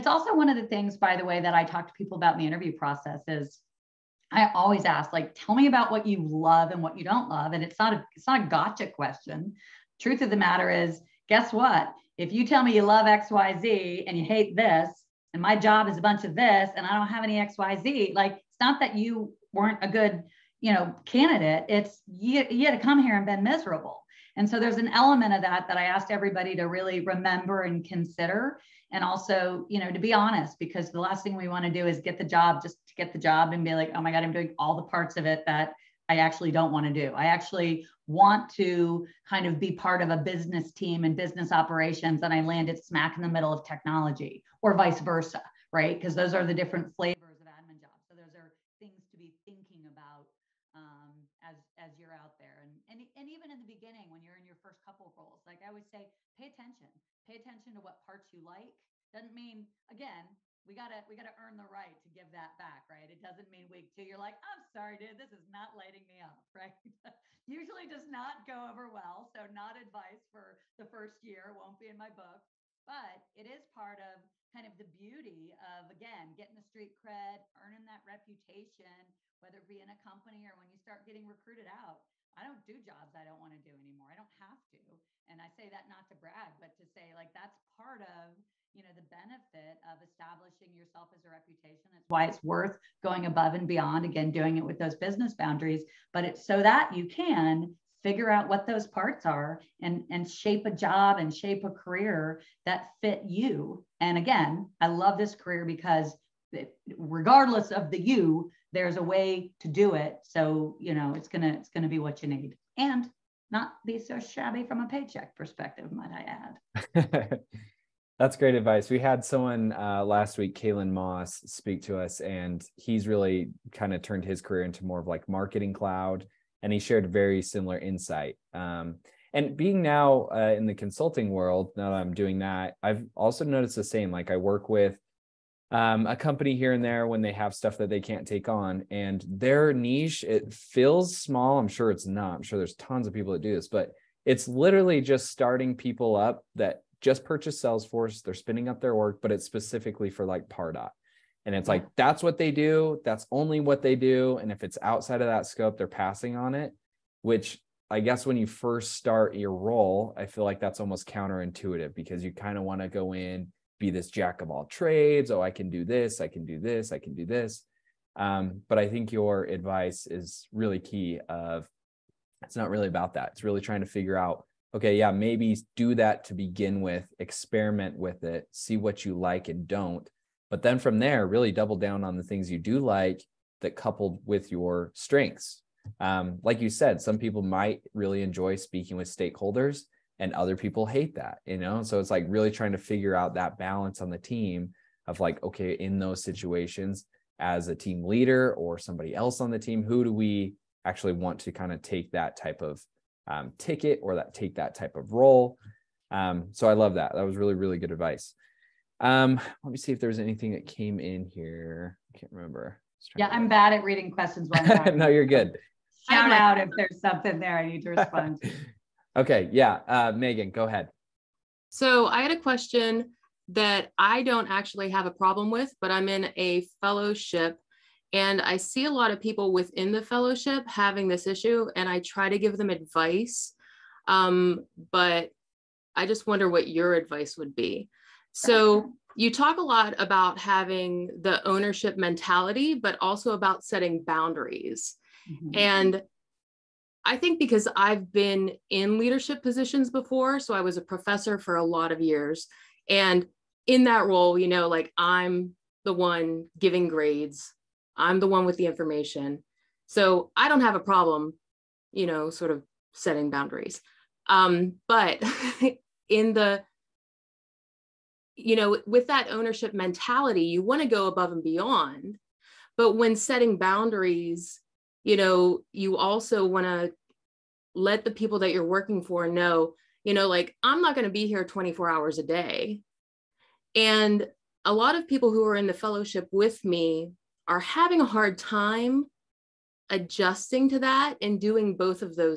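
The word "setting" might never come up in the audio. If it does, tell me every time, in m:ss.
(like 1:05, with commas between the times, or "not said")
4:03, 4:22, 4:33.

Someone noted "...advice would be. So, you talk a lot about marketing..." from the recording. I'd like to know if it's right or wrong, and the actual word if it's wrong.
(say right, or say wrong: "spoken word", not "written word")
wrong: "having", not "marketing".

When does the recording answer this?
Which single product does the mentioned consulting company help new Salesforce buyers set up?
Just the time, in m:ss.
2:30.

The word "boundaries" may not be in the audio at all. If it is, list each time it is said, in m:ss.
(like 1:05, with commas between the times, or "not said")
1:35, 4:04, 4:23, 4:33.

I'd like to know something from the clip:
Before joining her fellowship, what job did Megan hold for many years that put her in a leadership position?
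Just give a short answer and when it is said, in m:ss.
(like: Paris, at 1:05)
Professor, at 4:10.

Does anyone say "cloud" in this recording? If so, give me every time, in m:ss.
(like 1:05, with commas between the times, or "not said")
2:05.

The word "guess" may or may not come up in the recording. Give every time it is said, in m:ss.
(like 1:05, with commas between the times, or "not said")
0:11, 2:38.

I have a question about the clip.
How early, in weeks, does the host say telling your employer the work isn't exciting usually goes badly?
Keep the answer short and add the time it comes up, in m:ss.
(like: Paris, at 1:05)
Week 2, at 1:03.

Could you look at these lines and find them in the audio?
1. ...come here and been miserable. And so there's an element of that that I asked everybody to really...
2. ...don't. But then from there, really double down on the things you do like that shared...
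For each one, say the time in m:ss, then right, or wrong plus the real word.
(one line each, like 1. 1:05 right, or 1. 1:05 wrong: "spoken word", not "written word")
1. 0:22 right
2. 2:59 wrong: "coupled", not "shared".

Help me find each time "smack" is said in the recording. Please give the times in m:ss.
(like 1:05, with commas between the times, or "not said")
0:42.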